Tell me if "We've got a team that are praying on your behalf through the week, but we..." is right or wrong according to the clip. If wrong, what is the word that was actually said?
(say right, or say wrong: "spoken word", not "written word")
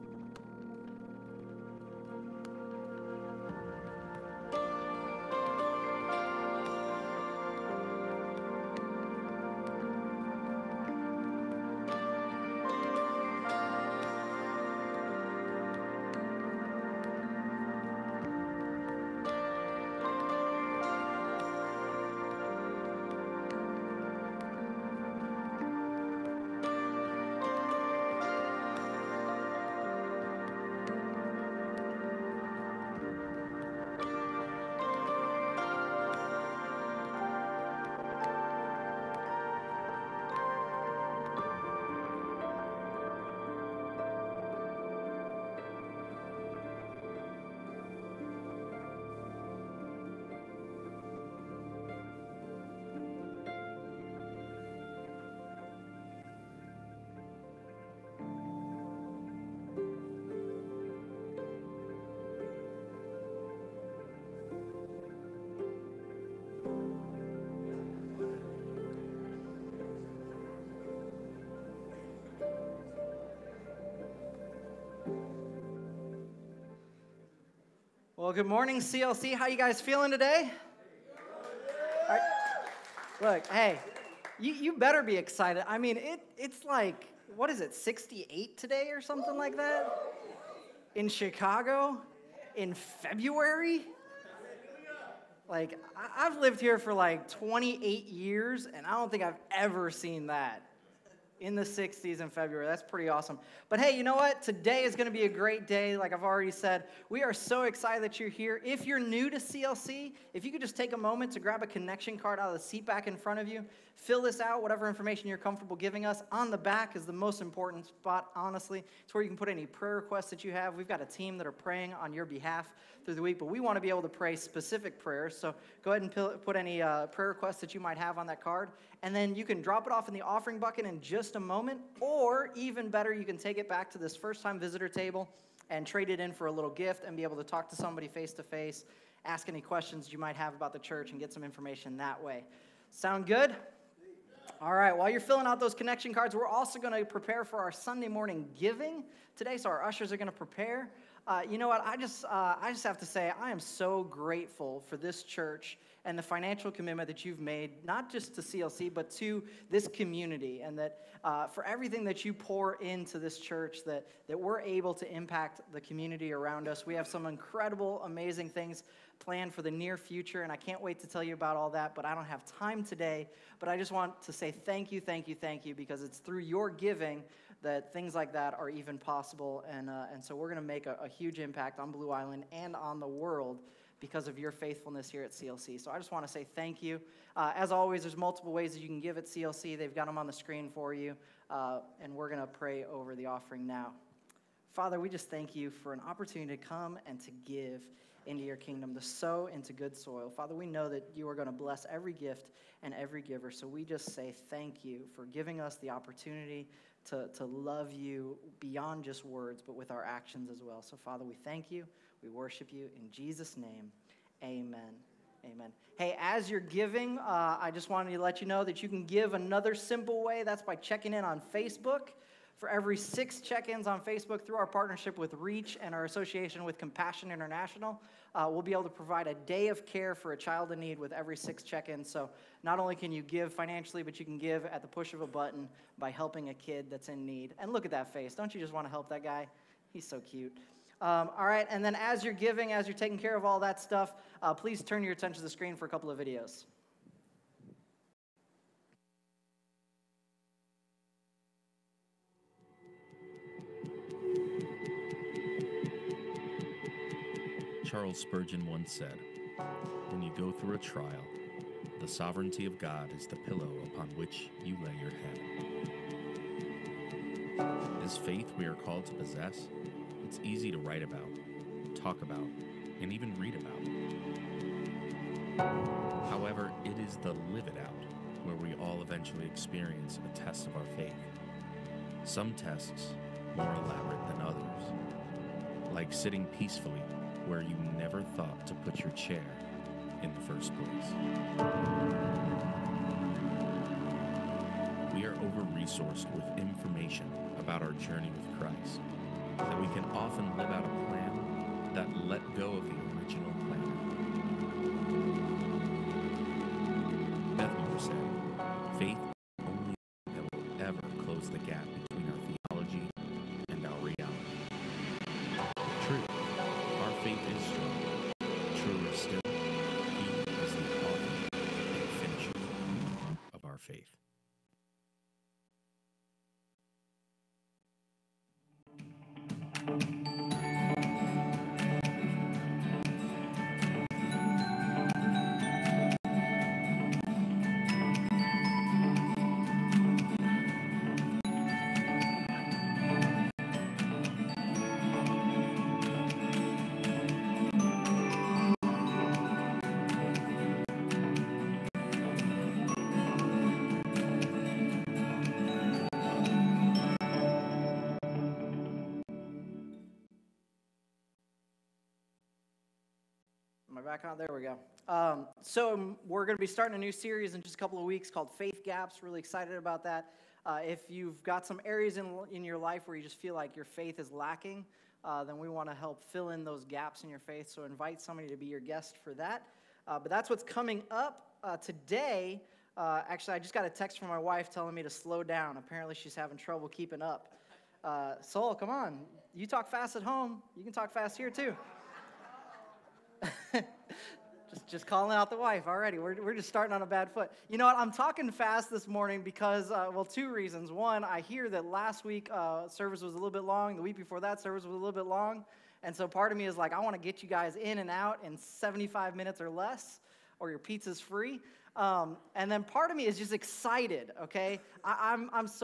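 right.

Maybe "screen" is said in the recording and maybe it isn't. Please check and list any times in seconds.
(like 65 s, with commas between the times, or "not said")
190 s, 245 s.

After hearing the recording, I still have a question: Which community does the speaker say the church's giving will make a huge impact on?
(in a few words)
Blue Island.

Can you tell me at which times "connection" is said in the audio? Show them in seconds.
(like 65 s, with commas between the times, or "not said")
111 s, 145 s.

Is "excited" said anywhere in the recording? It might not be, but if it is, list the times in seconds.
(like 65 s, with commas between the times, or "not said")
85 s, 107 s, 369 s, 413 s.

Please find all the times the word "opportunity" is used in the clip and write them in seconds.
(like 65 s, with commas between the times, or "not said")
196 s, 205 s.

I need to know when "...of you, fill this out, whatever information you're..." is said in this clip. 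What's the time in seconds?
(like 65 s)
113 s.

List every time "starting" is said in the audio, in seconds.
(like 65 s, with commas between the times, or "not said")
366 s, 396 s.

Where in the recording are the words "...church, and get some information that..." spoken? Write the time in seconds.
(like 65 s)
140 s.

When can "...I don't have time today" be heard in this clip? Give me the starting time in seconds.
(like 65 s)
172 s.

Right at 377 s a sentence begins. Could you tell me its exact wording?
So, invite somebody to be your guest for that.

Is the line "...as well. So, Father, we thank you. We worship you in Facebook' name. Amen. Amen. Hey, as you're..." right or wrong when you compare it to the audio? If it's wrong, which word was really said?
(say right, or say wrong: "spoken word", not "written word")
wrong: "Jesus", not "Facebook".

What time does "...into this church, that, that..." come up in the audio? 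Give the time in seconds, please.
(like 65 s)
162 s.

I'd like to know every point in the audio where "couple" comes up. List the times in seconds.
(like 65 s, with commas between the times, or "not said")
245 s, 367 s.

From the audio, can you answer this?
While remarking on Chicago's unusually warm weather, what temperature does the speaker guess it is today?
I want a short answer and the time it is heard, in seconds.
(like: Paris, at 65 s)
68, at 87 s.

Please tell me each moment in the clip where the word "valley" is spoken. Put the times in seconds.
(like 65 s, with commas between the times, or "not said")
not said.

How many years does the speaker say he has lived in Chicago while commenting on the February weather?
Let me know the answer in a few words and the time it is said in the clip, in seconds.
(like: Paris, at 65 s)
28, at 97 s.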